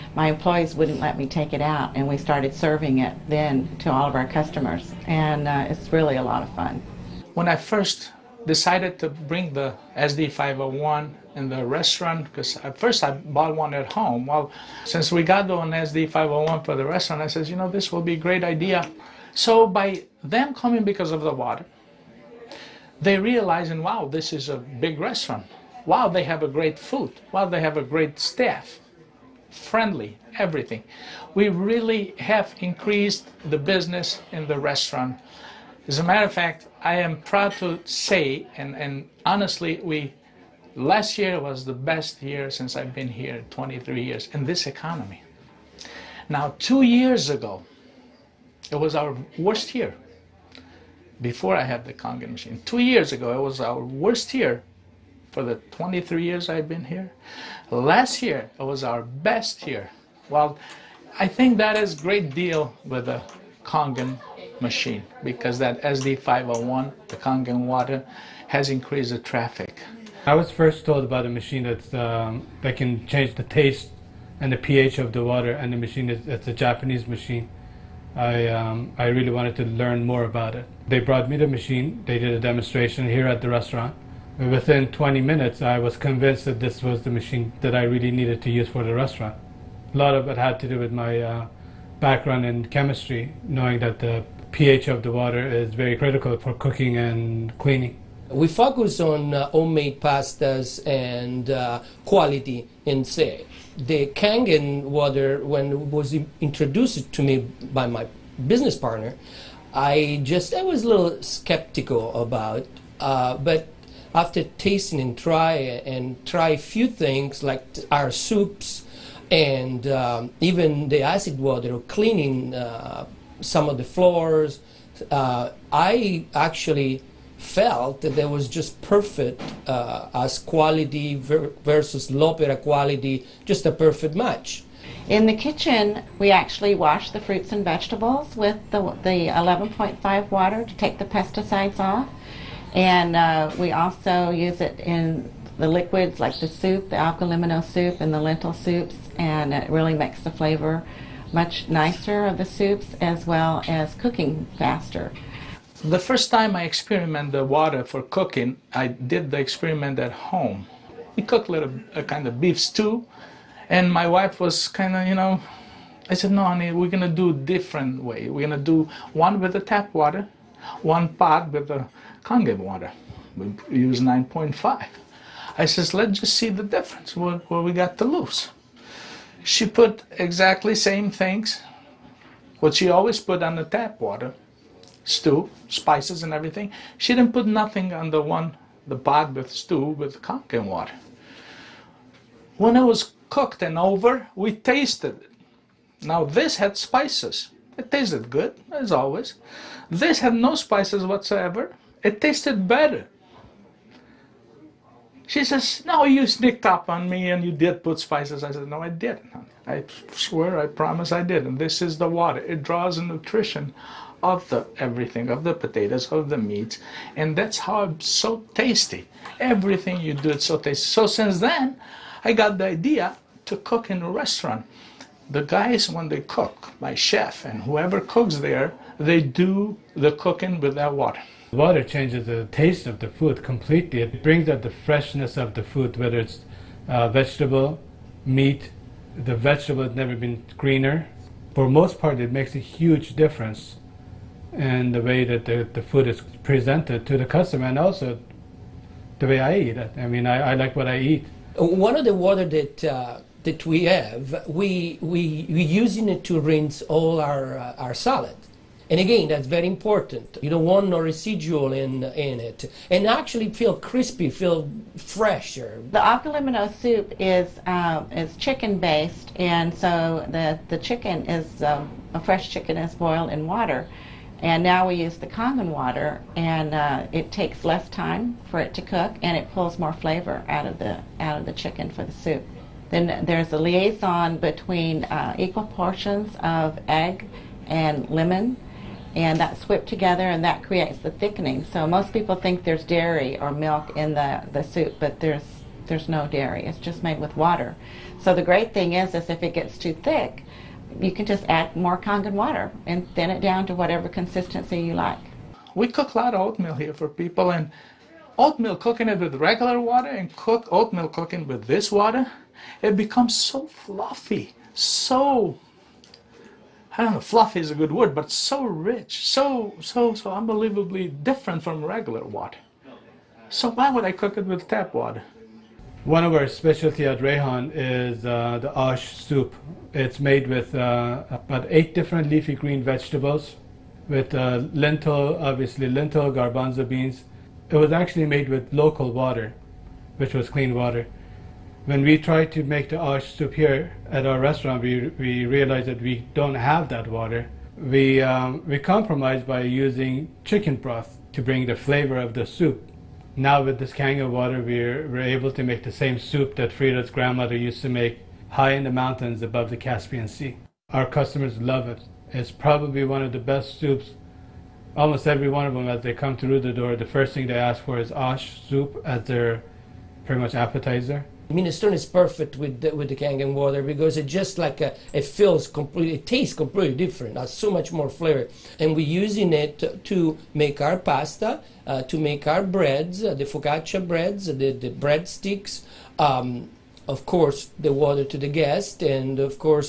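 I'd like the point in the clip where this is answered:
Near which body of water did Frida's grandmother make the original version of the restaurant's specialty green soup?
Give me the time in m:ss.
5:59.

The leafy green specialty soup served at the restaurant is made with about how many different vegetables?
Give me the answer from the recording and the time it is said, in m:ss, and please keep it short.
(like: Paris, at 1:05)
8, at 5:31.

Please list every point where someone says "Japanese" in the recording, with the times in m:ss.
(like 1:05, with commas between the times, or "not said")
1:16.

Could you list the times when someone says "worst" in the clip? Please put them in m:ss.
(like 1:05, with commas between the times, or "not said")
0:49, 0:53.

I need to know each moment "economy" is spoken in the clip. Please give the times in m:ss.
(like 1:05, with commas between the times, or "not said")
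0:44.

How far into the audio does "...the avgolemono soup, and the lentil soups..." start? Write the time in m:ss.
2:26.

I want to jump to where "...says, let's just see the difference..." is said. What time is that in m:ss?
2:55.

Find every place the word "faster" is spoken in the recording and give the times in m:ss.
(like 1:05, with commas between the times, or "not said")
2:34.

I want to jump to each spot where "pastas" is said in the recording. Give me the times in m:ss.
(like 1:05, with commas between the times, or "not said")
1:40, 6:20.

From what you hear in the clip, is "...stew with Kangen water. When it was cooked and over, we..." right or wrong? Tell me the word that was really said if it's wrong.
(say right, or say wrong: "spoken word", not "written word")
right.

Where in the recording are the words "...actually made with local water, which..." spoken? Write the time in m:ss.
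5:37.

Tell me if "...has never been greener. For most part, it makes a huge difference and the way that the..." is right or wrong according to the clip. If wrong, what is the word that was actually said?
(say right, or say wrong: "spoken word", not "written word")
right.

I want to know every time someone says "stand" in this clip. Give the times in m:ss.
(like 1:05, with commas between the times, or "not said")
not said.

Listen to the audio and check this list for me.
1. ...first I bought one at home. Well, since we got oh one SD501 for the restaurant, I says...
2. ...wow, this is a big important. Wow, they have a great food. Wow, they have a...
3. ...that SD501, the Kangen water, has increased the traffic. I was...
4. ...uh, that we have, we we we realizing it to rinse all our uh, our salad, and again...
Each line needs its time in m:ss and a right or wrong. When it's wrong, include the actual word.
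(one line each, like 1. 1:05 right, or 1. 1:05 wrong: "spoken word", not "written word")
1. 0:12 right
2. 0:23 wrong: "restaurant", not "important"
3. 1:05 right
4. 4:12 wrong: "using", not "realizing".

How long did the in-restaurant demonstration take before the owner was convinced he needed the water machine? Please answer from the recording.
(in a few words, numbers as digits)
20 minutes.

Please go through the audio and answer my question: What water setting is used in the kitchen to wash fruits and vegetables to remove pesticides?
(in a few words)
11.5.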